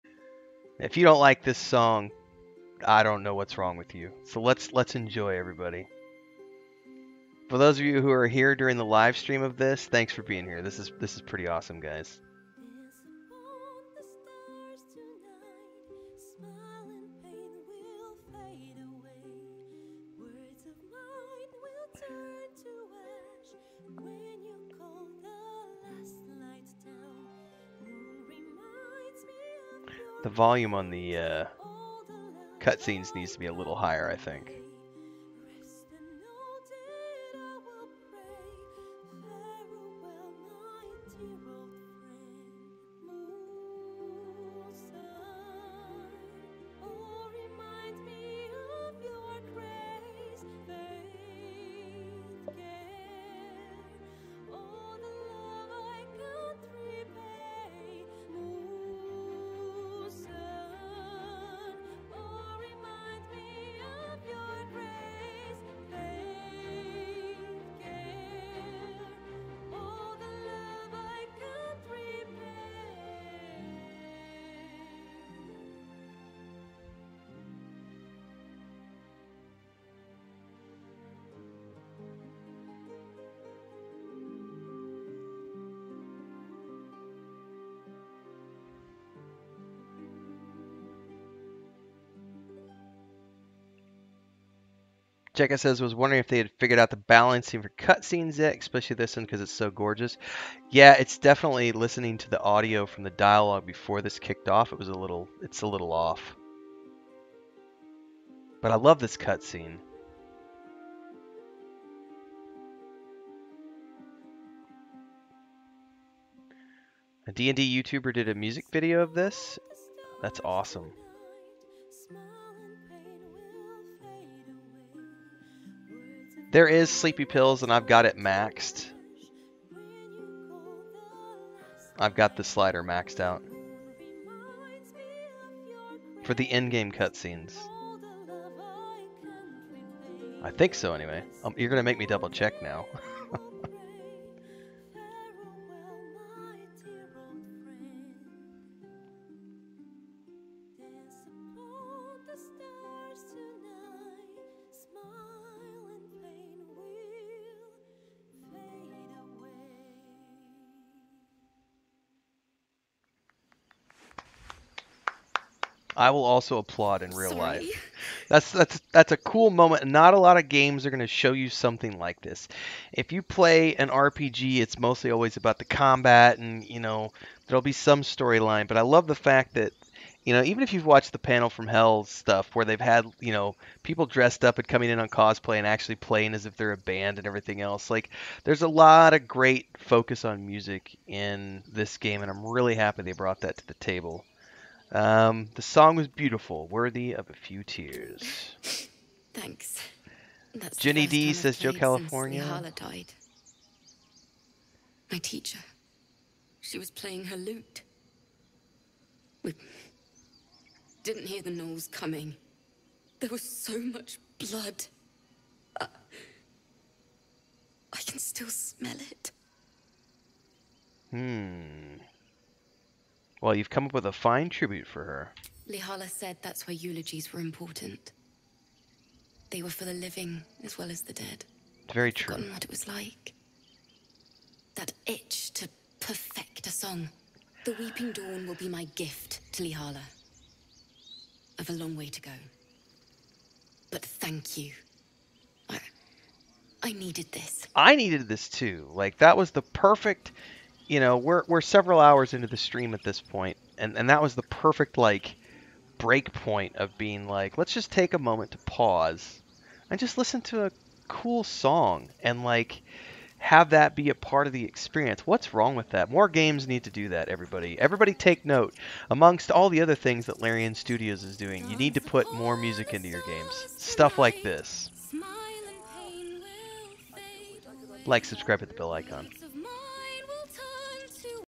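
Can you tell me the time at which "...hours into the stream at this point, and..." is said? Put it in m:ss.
4:11.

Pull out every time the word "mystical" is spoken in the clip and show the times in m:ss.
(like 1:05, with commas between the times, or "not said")
not said.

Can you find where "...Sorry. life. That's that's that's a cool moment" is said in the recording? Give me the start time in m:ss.
2:47.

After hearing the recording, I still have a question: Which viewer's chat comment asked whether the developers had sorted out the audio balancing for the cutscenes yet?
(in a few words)
Jekka.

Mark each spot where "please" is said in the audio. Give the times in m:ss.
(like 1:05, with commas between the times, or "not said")
not said.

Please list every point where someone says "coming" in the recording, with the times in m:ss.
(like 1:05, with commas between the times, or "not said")
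3:04, 3:31.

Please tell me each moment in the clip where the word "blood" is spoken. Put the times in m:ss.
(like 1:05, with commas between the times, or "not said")
3:34.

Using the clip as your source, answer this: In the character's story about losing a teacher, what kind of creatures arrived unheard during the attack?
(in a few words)
gnolls.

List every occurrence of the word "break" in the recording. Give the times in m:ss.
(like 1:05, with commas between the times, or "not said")
4:15.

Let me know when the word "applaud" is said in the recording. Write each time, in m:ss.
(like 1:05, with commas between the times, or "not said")
2:46.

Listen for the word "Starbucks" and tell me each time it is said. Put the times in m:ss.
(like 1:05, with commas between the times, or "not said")
not said.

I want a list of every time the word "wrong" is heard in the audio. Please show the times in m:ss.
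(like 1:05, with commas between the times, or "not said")
0:03, 4:25.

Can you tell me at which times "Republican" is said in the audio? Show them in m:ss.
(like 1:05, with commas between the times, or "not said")
not said.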